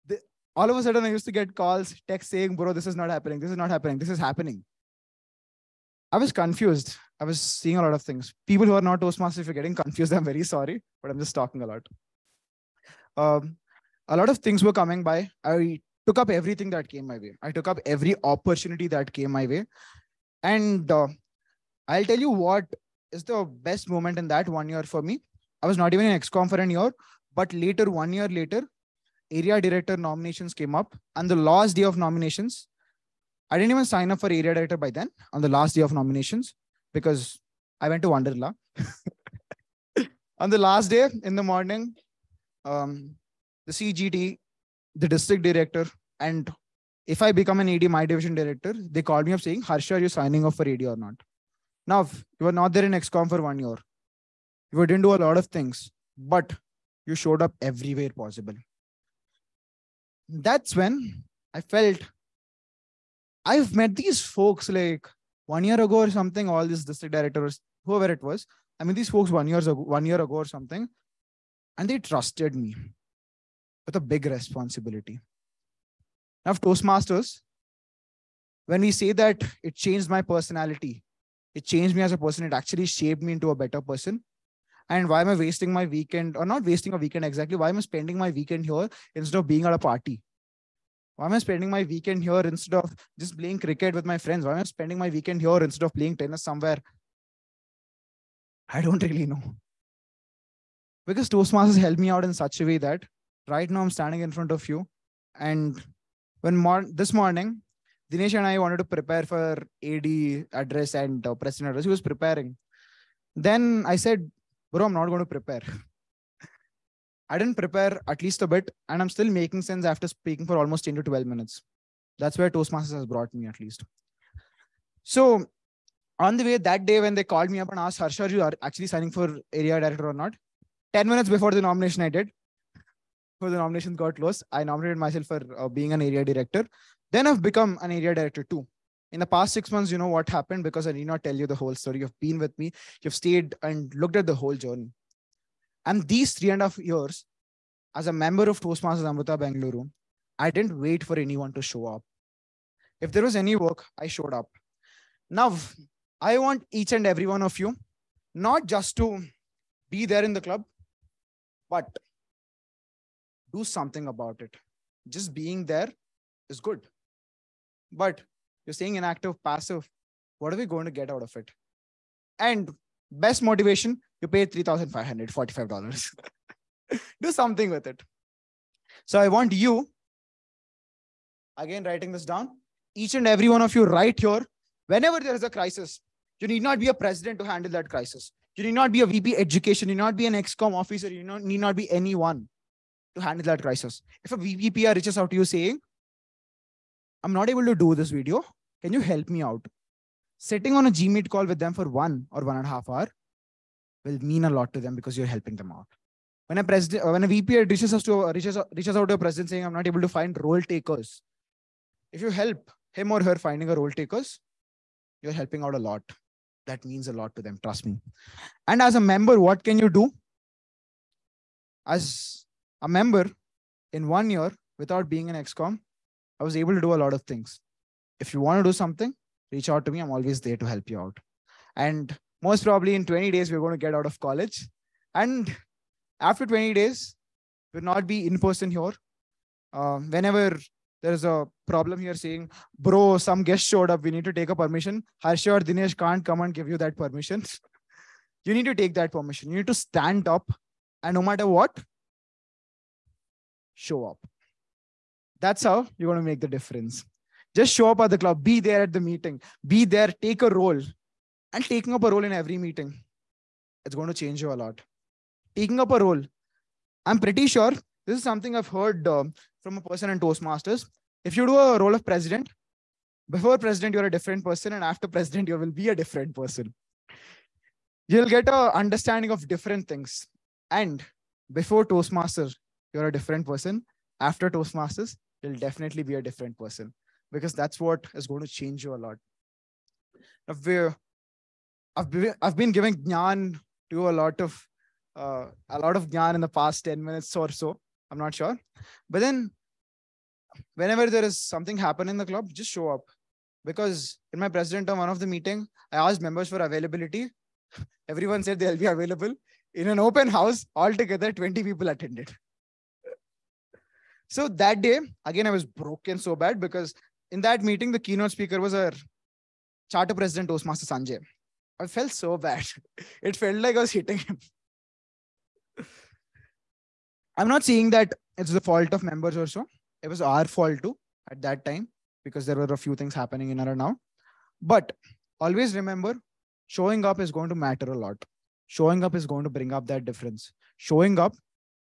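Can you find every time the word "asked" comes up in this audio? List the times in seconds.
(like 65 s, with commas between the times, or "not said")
127 s, 305 s.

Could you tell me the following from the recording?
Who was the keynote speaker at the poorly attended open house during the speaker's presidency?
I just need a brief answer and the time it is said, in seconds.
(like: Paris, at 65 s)
Toastmaster Sanjay, at 320 s.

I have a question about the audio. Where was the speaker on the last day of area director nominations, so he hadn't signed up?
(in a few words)
Wonderla.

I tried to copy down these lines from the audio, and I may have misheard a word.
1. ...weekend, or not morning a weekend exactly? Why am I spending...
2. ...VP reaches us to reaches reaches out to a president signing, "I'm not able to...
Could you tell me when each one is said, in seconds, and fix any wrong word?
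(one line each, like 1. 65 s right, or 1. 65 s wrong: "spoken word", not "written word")
1. 85 s wrong: "wasting", not "morning"
2. 207 s wrong: "saying", not "signing".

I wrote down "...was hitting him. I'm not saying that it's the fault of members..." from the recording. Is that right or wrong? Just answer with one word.
right.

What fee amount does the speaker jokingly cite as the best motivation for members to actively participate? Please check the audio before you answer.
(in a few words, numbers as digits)
$3,545.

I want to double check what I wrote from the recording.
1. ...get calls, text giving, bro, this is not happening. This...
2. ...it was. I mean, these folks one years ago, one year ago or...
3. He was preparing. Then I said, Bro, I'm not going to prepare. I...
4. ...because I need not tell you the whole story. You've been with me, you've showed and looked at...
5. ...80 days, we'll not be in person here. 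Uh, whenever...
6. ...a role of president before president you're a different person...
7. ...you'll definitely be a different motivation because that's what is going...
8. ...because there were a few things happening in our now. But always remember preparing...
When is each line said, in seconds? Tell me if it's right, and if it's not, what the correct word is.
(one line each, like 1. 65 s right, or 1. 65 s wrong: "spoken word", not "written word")
1. 1 s wrong: "saying", not "giving"
2. 68 s right
3. 111 s right
4. 140 s wrong: "stayed", not "showed"
5. 236 s wrong: "20", not "80"
6. 271 s right
7. 285 s wrong: "person", not "motivation"
8. 332 s wrong: "showing", not "preparing".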